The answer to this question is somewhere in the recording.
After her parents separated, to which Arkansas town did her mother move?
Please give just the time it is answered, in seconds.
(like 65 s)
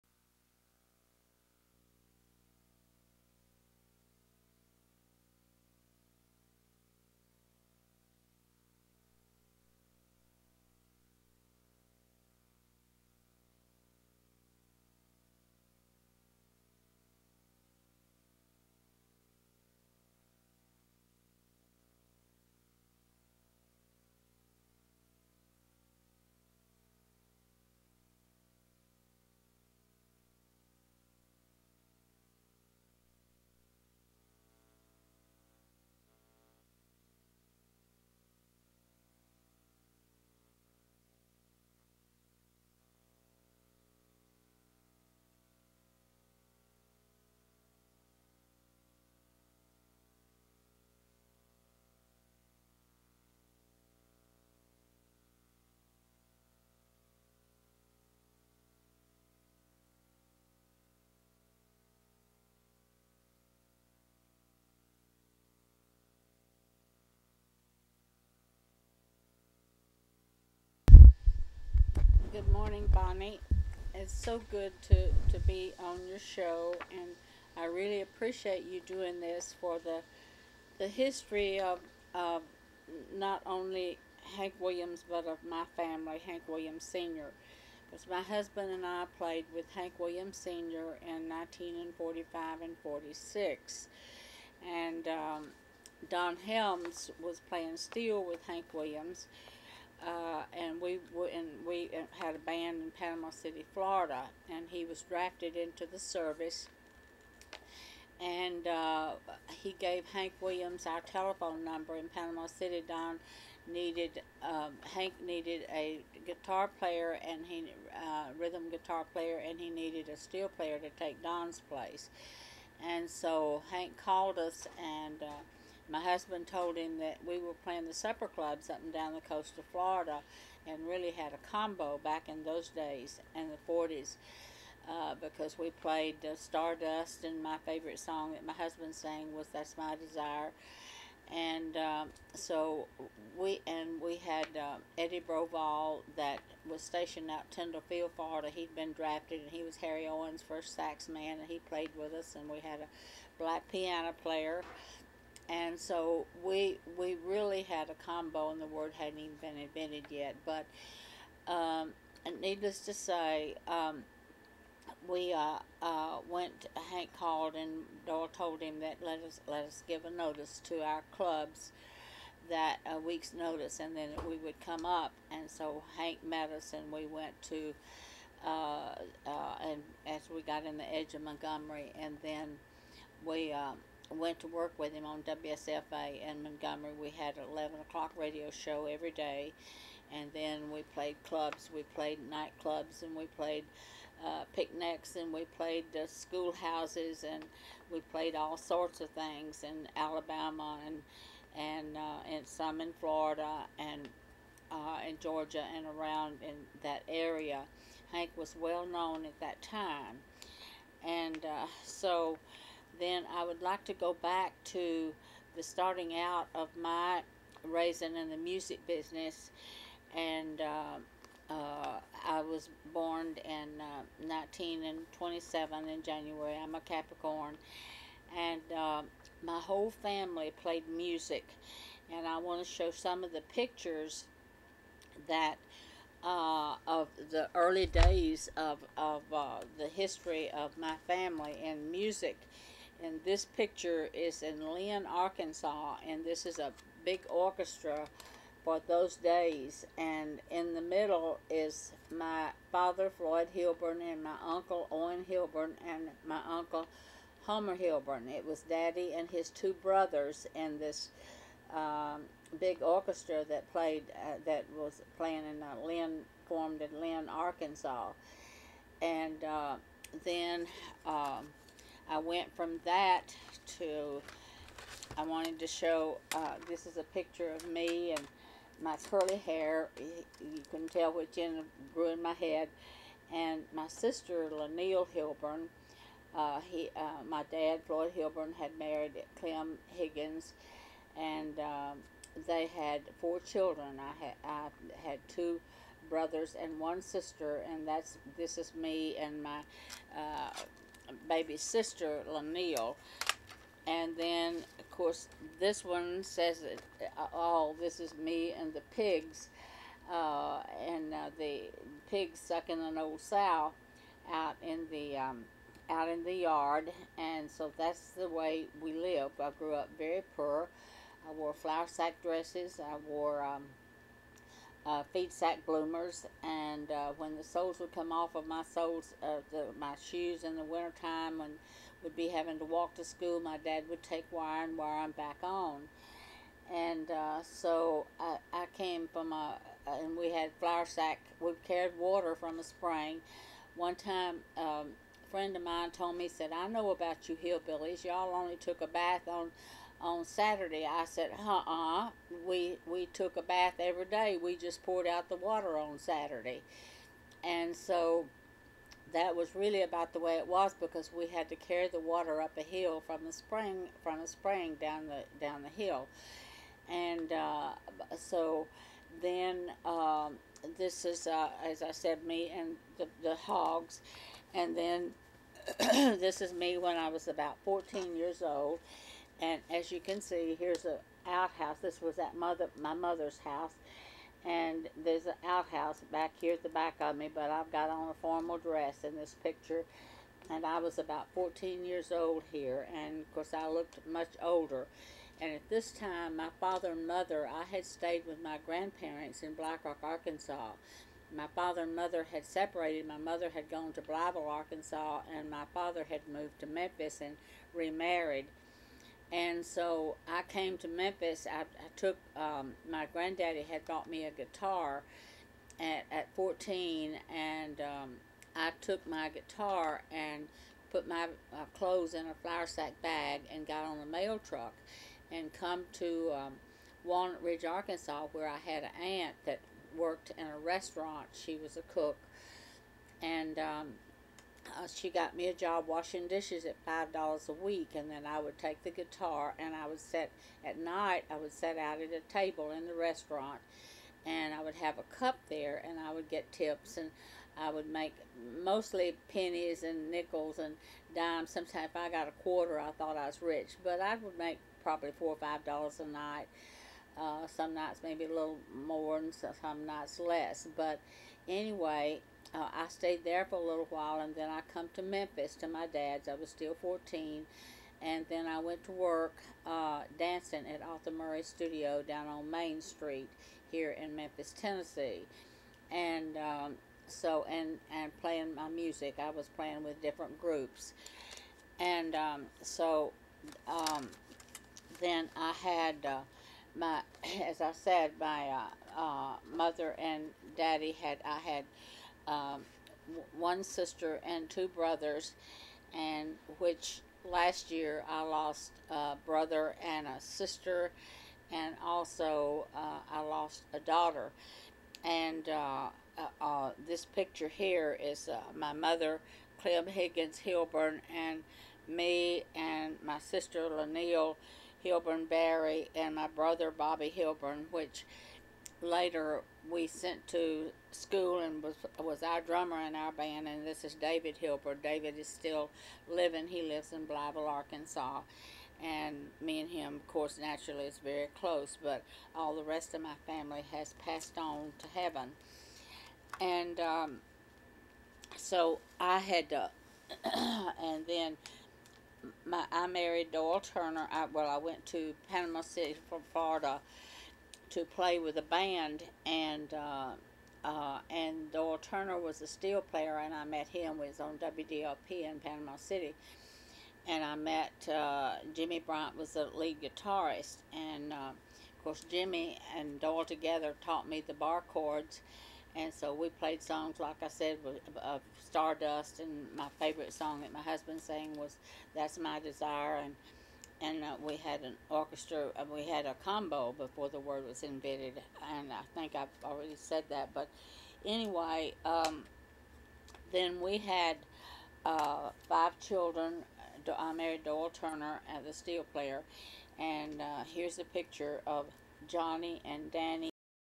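404 s.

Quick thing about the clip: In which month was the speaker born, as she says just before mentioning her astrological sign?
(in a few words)
January.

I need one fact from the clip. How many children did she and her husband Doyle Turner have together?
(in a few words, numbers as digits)
5.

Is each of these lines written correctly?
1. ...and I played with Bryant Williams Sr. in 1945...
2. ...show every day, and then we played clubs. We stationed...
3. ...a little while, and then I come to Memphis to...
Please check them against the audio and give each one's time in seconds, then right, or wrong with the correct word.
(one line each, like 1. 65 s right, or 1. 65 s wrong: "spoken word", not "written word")
1. 88 s wrong: "Hank", not "Bryant"
2. 188 s wrong: "played", not "stationed"
3. 463 s right.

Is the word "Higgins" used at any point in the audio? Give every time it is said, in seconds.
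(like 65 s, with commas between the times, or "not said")
289 s, 509 s.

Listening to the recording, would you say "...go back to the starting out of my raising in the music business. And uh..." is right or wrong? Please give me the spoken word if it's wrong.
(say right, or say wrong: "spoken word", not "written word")
right.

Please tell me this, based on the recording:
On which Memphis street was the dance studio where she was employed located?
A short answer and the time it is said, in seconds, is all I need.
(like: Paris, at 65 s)
Main Street, at 472 s.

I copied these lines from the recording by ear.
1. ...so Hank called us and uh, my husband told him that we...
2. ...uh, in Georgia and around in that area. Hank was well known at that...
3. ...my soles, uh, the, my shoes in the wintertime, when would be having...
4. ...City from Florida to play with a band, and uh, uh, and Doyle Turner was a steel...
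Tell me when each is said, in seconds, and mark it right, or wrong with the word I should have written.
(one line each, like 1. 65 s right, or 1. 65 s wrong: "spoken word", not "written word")
1. 123 s right
2. 204 s right
3. 328 s right
4. 545 s right.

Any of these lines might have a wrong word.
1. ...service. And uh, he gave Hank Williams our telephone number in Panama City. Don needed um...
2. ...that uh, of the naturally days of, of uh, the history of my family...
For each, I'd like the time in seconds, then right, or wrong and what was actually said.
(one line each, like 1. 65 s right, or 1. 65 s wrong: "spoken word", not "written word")
1. 105 s right
2. 235 s wrong: "early", not "naturally".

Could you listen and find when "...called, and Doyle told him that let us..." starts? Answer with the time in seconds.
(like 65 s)
167 s.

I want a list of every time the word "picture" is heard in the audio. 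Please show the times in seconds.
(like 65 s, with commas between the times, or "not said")
233 s, 243 s, 277 s, 389 s, 507 s, 590 s.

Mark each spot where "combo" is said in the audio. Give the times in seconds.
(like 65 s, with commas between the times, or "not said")
131 s, 158 s, 576 s.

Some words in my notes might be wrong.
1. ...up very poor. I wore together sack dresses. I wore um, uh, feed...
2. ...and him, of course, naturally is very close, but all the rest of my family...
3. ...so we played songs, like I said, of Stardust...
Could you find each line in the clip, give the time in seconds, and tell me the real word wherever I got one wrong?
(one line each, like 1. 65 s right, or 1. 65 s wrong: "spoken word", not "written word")
1. 319 s wrong: "flower", not "together"
2. 529 s right
3. 565 s right.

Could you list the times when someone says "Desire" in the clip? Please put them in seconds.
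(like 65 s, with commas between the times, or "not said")
139 s, 572 s.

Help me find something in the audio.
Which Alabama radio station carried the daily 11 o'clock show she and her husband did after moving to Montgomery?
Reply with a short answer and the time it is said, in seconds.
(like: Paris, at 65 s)
WSFA, at 185 s.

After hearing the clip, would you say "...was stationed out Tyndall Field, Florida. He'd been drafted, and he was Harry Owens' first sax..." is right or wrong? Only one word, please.
right.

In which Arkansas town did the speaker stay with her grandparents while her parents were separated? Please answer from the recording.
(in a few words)
Black Rock.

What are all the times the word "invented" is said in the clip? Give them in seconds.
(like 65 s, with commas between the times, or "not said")
159 s, 577 s.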